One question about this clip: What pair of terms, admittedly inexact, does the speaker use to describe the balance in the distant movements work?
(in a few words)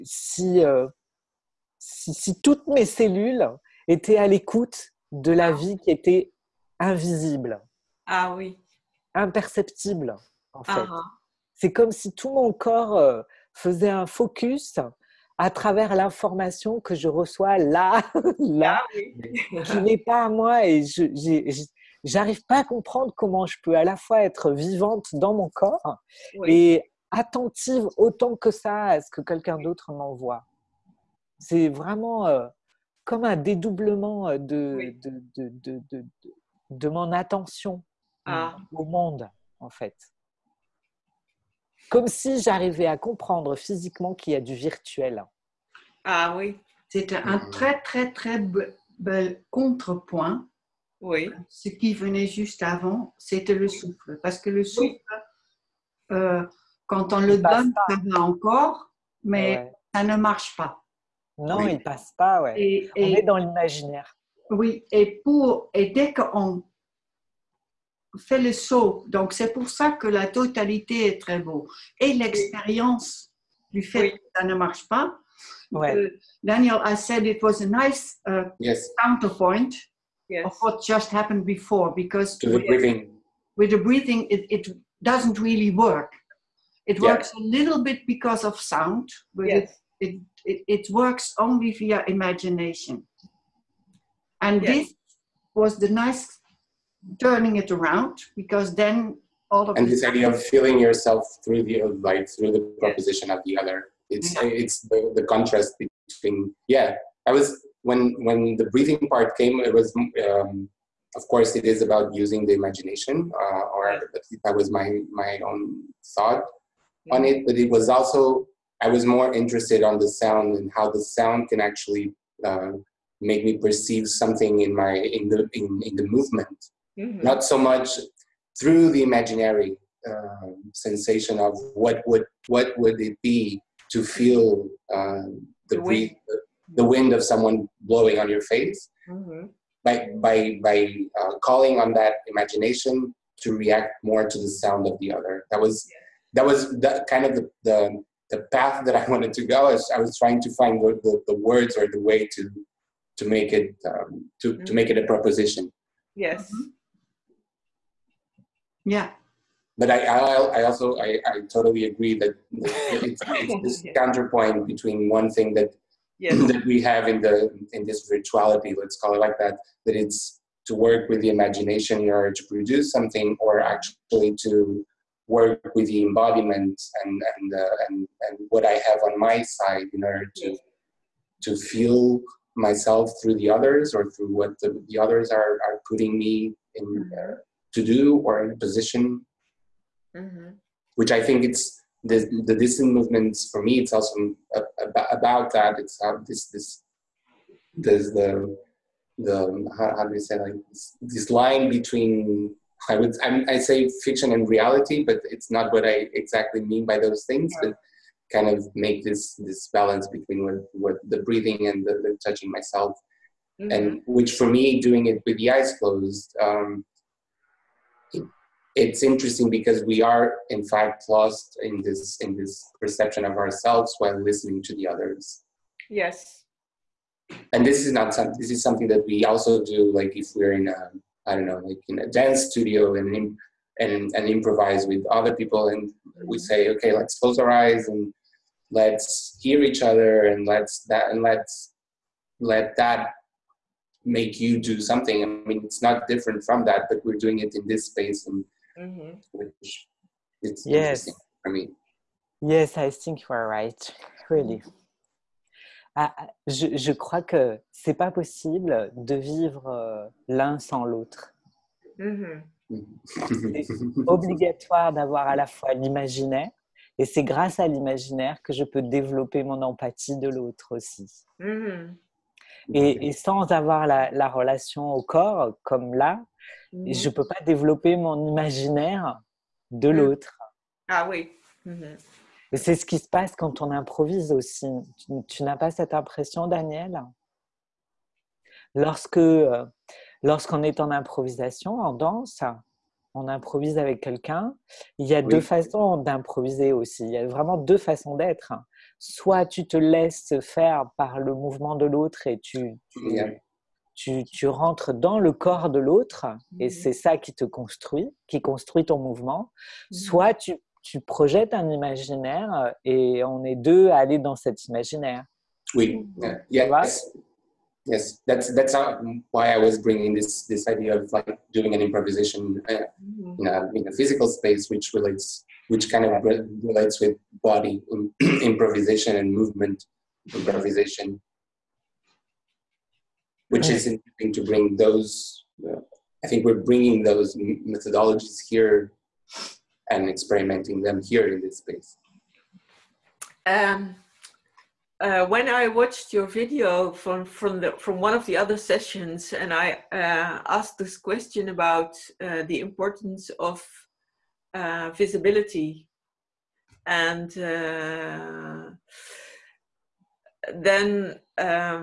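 fiction and reality.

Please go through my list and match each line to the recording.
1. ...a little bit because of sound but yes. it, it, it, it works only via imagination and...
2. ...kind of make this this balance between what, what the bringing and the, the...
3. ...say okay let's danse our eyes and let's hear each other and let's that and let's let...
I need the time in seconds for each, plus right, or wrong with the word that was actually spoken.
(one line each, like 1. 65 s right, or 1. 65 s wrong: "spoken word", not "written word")
1. 87 s right
2. 208 s wrong: "breathing", not "bringing"
3. 236 s wrong: "close", not "danse".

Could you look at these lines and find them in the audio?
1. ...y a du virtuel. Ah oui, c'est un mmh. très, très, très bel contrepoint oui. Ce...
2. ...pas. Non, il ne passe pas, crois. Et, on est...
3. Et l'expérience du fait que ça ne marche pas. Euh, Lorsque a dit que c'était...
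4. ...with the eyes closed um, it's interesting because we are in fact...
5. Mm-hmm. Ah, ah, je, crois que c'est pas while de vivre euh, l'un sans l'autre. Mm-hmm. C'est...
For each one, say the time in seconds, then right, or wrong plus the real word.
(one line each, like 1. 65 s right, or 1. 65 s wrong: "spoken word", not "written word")
1. 44 s right
2. 60 s wrong: "ouais", not "crois"
3. 71 s wrong: "Daniel", not "Lorsque"
4. 215 s right
5. 254 s wrong: "possible", not "while".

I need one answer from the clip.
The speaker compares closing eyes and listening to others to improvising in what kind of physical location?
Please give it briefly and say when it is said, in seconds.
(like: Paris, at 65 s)
a dance studio, at 232 s.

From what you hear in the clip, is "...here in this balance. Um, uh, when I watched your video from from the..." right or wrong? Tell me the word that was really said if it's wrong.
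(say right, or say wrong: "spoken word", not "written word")
wrong: "space", not "balance".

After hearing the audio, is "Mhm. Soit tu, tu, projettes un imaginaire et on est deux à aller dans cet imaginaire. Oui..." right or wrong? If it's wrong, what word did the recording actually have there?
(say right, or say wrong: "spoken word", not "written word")
right.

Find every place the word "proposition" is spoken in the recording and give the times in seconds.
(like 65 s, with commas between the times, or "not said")
102 s, 155 s.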